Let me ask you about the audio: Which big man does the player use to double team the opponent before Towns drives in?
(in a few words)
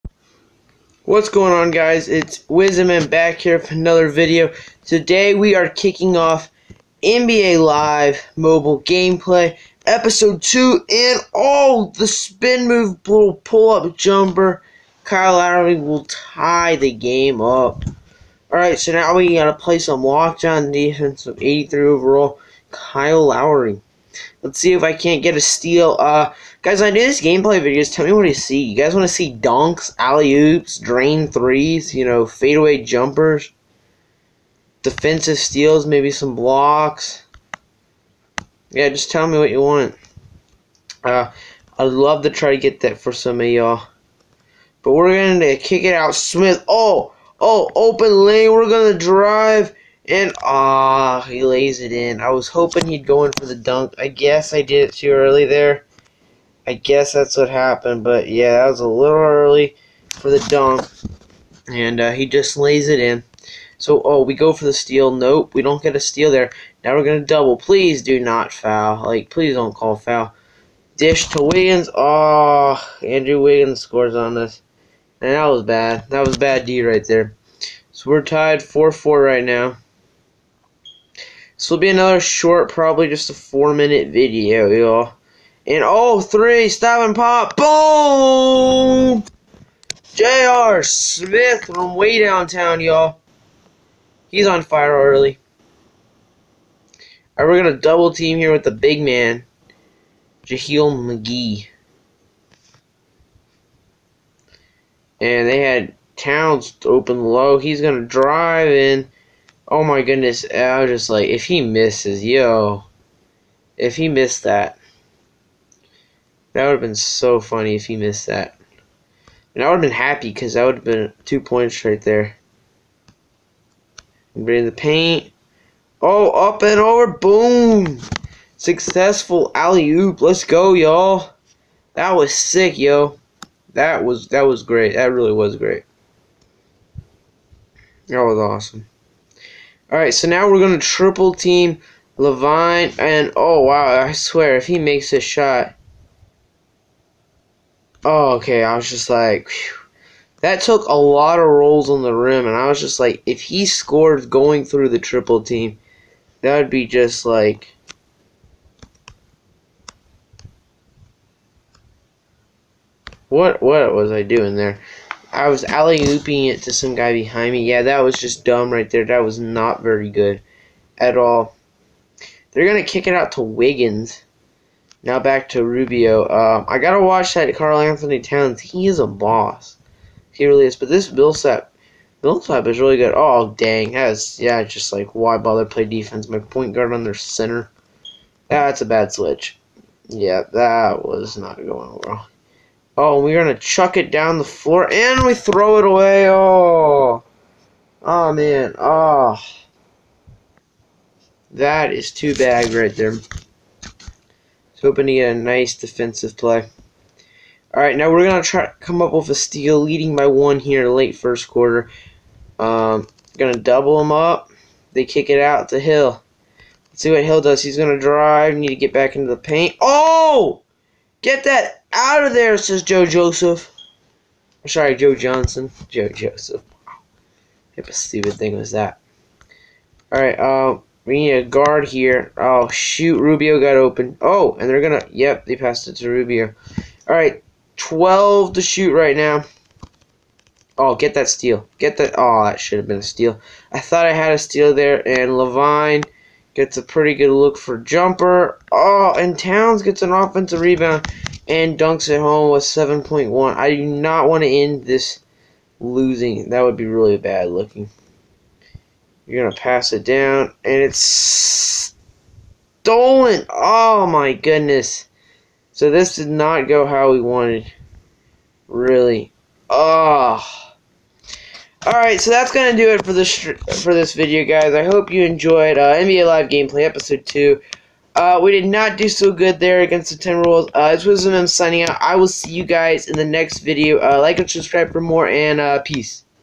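JaVale McGee.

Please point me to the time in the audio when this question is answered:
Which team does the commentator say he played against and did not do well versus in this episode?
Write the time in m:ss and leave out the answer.
4:40.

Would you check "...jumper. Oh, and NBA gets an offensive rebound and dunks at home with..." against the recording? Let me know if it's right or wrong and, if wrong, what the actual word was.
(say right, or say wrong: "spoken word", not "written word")
wrong: "Towns", not "NBA".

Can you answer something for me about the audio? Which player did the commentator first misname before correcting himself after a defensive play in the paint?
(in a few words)
Joe Johnson.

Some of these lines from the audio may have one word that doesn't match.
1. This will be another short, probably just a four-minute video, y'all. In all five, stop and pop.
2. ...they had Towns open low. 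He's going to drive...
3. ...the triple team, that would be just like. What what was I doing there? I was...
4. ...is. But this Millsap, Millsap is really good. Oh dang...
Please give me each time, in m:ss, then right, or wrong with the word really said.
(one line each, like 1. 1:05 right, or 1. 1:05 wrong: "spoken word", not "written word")
1. 1:21 wrong: "three", not "five"
2. 1:45 right
3. 2:34 right
4. 3:00 right.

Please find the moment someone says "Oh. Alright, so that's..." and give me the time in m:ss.
4:29.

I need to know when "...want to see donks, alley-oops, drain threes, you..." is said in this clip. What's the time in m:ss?
0:28.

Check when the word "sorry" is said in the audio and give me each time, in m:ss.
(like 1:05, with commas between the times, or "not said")
3:44.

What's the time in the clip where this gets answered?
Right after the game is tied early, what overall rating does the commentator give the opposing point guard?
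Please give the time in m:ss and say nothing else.
0:21.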